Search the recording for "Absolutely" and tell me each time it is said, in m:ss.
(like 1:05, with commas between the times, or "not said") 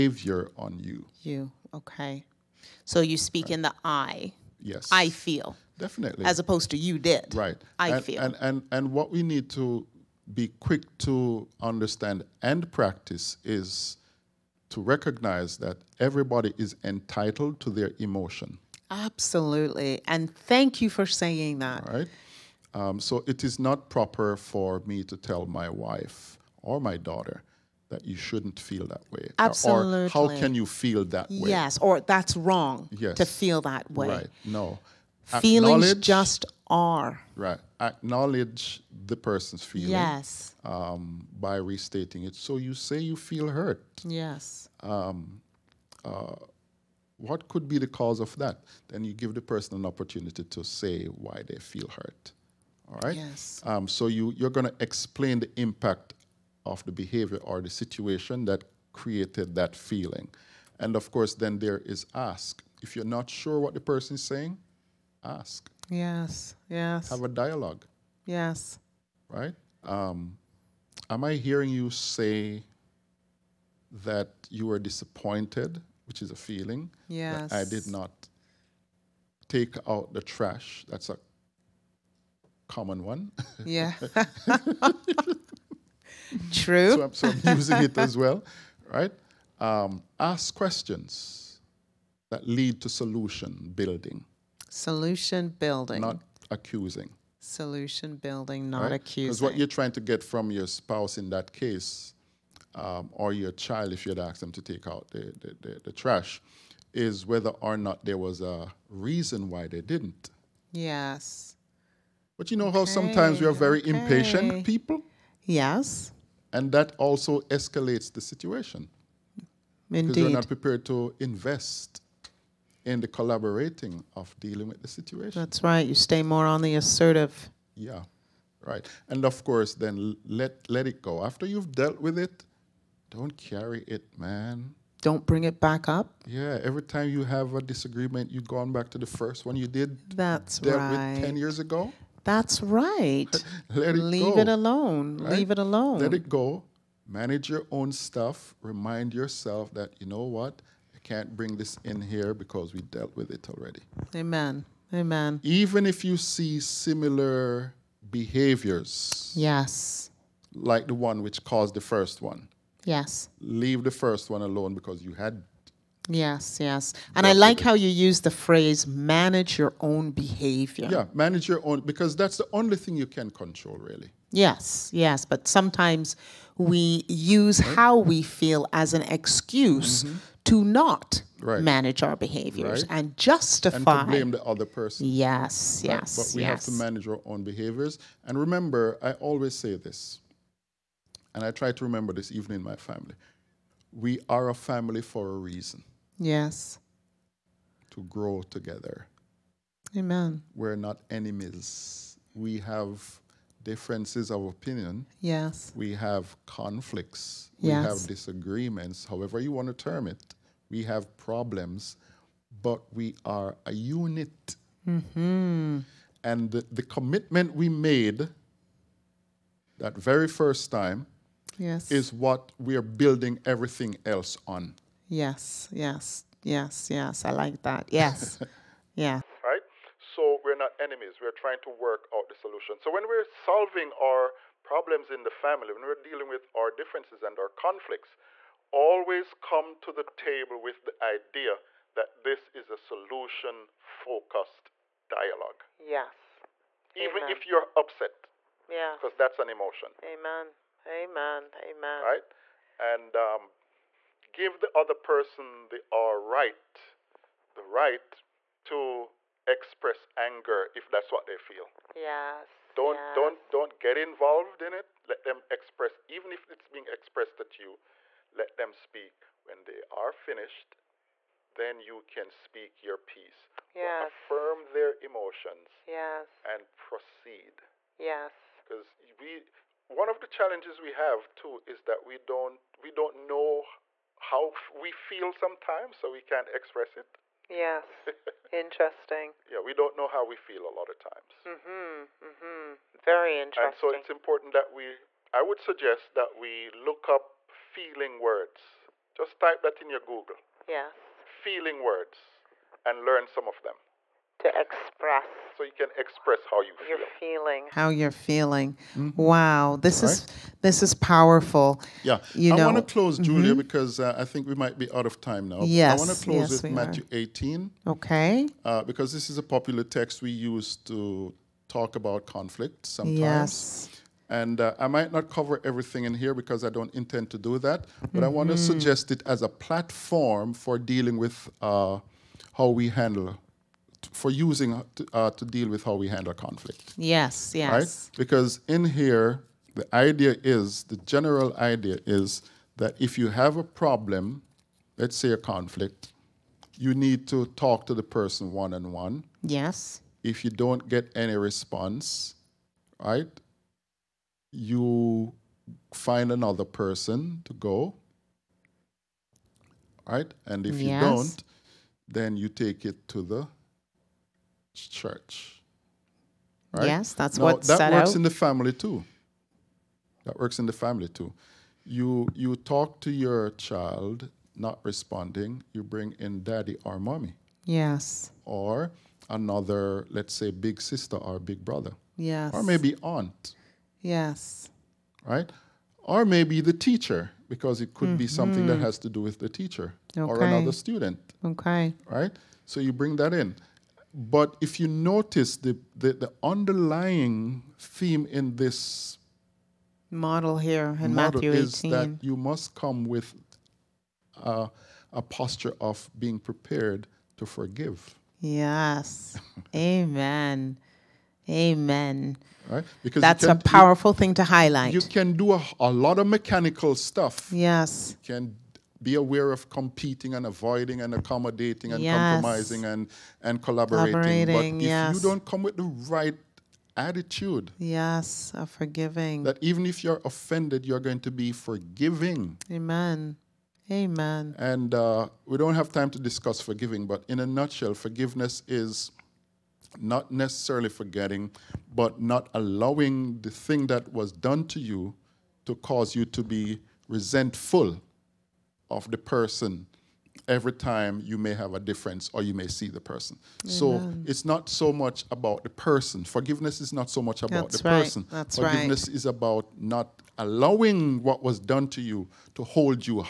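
0:18, 0:29.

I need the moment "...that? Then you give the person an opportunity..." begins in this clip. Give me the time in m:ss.
0:48.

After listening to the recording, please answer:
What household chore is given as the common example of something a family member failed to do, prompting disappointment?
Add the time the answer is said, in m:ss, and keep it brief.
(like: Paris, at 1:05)
Take out the trash, at 1:19.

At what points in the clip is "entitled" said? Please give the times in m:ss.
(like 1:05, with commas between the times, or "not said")
0:16.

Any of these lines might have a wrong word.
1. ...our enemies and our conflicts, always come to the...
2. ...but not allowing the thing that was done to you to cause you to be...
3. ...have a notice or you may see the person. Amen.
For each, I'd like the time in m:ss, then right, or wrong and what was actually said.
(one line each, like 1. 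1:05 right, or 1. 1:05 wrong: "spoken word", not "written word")
1. 3:56 wrong: "differences", not "enemies"
2. 7:21 right
3. 7:31 wrong: "difference", not "notice".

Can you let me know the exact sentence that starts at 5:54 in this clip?
you find another person to go, right?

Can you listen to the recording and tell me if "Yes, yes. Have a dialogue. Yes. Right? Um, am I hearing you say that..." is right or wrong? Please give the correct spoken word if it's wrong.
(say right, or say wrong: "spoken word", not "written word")
right.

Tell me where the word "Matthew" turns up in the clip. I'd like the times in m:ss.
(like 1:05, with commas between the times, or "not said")
5:16, 6:41.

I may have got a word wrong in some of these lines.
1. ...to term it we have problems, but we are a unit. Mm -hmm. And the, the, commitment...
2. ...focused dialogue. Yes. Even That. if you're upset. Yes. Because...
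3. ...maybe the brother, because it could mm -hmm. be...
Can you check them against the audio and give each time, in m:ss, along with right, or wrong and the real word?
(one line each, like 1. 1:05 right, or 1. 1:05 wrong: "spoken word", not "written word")
1. 3:29 right
2. 4:03 wrong: "Amen", not "That"
3. 6:26 wrong: "teacher", not "brother".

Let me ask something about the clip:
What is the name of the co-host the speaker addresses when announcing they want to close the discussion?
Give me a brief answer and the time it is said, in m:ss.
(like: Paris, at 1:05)
Julia, at 5:13.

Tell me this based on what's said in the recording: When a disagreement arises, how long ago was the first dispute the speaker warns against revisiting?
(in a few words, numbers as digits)
10 years ago.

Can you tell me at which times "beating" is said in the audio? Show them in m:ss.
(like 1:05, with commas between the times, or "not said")
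not said.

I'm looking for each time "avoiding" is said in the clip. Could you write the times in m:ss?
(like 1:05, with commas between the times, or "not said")
7:00.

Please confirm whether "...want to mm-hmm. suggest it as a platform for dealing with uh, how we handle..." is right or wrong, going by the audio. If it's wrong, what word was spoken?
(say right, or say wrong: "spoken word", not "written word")
right.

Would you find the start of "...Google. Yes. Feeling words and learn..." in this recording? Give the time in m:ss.
4:59.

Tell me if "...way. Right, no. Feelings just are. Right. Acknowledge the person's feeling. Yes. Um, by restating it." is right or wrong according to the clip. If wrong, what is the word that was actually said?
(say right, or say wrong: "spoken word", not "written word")
right.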